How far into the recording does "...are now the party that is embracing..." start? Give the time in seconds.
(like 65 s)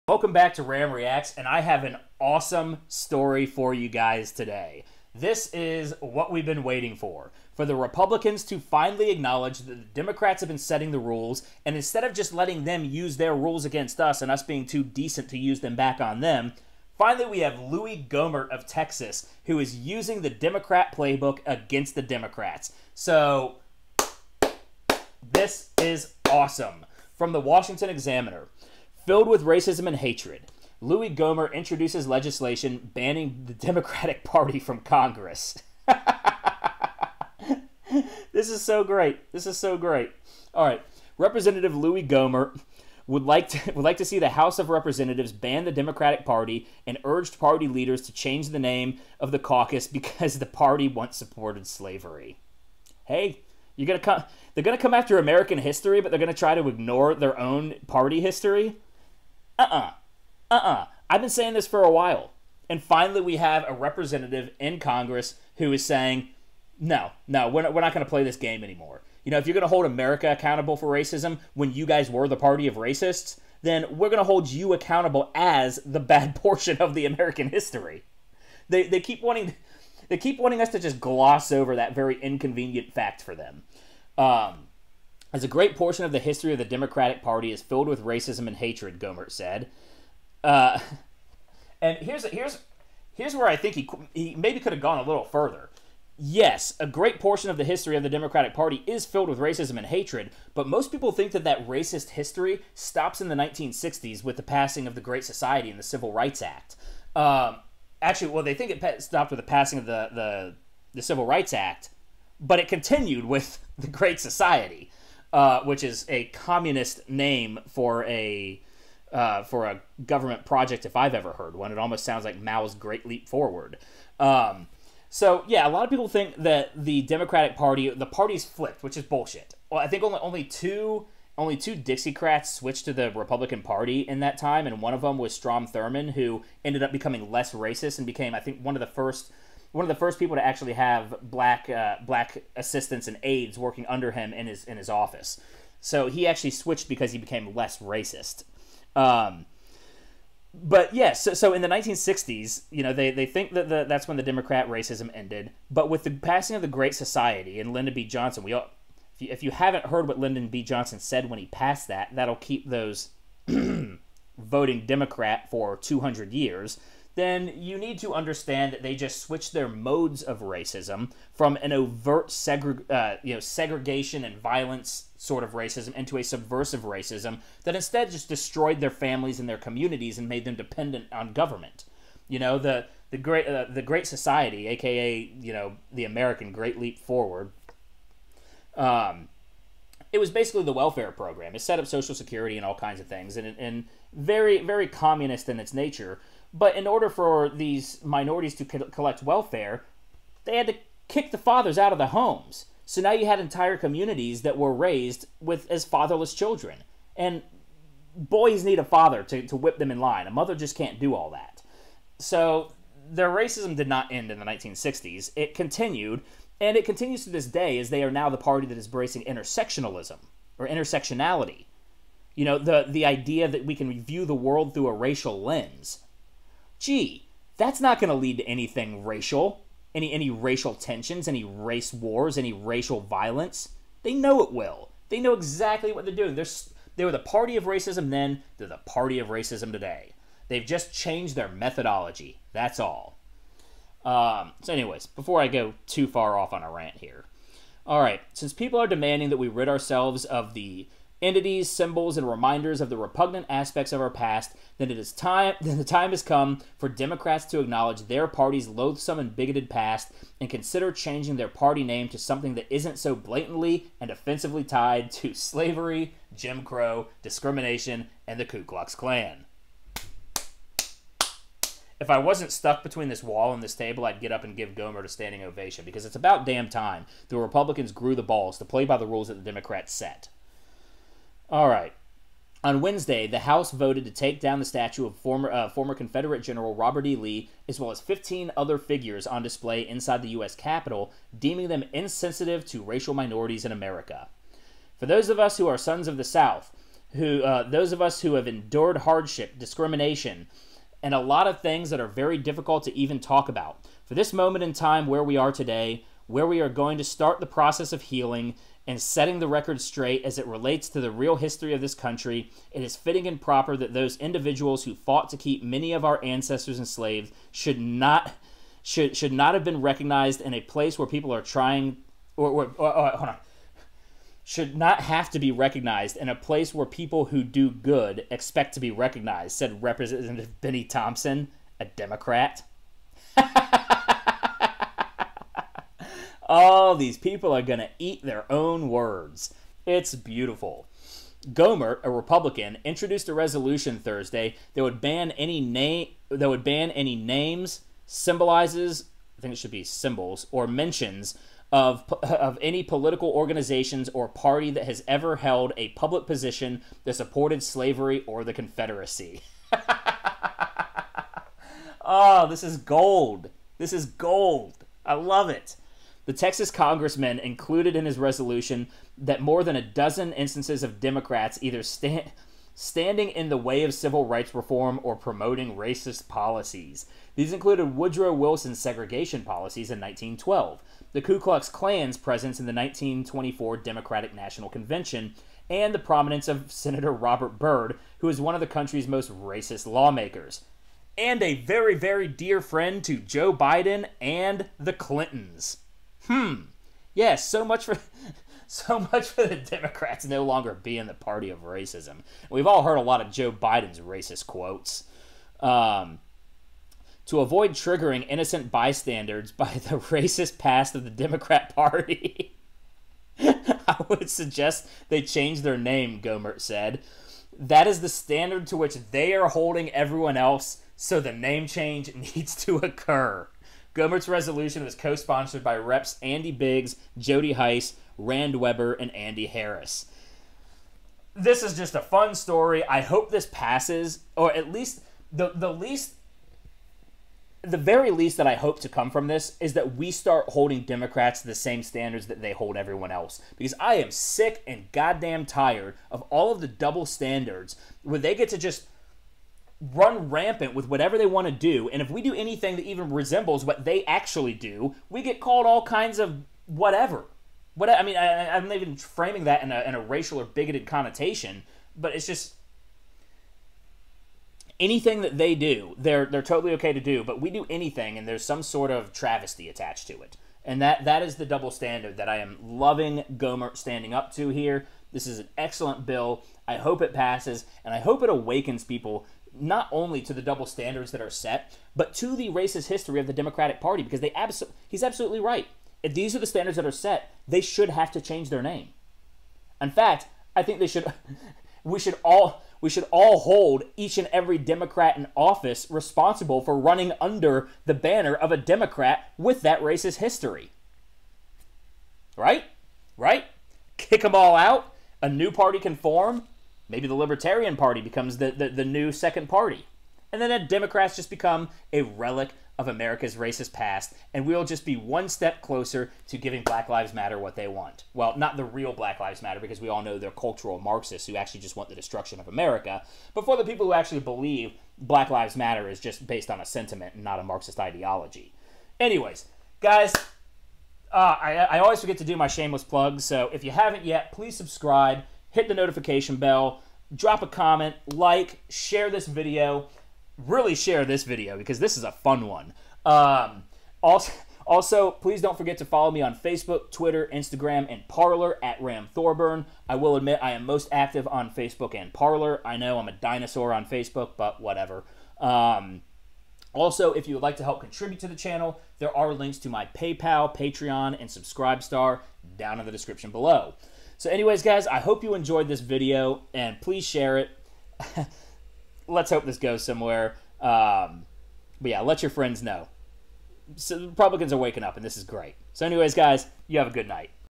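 218 s.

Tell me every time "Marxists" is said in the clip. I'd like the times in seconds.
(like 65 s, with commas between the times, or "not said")
520 s, 527 s.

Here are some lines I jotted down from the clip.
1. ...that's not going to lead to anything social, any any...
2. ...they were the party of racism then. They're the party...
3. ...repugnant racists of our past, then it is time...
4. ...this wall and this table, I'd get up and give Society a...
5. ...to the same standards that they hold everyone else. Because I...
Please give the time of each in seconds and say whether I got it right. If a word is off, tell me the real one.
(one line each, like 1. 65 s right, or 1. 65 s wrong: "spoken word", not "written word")
1. 227 s wrong: "racial", not "social"
2. 236 s right
3. 252 s wrong: "aspects", not "racists"
4. 273 s wrong: "Gohmert", not "Society"
5. 441 s right.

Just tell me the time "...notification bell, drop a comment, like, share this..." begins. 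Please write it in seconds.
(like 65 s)
535 s.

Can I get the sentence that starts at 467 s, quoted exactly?
But we do anything, and there's some sort of travesty attached to it.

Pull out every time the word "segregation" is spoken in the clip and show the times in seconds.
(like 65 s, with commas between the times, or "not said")
173 s, 378 s.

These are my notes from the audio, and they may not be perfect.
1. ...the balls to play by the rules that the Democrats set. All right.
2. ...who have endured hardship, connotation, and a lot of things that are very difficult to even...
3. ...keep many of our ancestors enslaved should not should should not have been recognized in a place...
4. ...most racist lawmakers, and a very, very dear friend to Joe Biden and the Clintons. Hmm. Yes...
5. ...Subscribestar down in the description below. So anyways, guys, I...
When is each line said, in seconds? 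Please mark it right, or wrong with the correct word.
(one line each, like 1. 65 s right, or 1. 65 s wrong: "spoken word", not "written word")
1. 278 s right
2. 298 s wrong: "discrimination", not "connotation"
3. 315 s right
4. 389 s right
5. 561 s right.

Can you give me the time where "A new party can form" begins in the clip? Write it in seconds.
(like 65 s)
505 s.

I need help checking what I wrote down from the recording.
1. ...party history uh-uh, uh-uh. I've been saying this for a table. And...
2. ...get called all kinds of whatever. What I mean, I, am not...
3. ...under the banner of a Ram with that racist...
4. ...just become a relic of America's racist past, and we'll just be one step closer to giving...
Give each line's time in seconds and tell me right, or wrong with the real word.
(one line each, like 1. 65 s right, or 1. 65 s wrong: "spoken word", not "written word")
1. 57 s wrong: "while", not "table"
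2. 455 s right
3. 497 s wrong: "Democrat", not "Ram"
4. 511 s right.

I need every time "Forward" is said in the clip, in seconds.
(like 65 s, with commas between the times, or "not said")
123 s, 186 s.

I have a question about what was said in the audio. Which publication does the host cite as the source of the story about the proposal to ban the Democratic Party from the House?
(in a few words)
Washington Examiner.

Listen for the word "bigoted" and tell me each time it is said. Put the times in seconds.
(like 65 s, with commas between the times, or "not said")
259 s, 460 s.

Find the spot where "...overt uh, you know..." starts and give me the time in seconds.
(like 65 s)
171 s.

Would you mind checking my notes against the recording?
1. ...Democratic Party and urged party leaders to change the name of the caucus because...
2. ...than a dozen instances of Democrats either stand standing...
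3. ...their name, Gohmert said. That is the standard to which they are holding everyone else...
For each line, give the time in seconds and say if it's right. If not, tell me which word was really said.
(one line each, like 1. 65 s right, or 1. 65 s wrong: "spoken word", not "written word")
1. 45 s right
2. 369 s right
3. 415 s right.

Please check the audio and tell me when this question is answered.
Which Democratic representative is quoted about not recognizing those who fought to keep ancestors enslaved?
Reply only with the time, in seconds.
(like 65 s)
330 s.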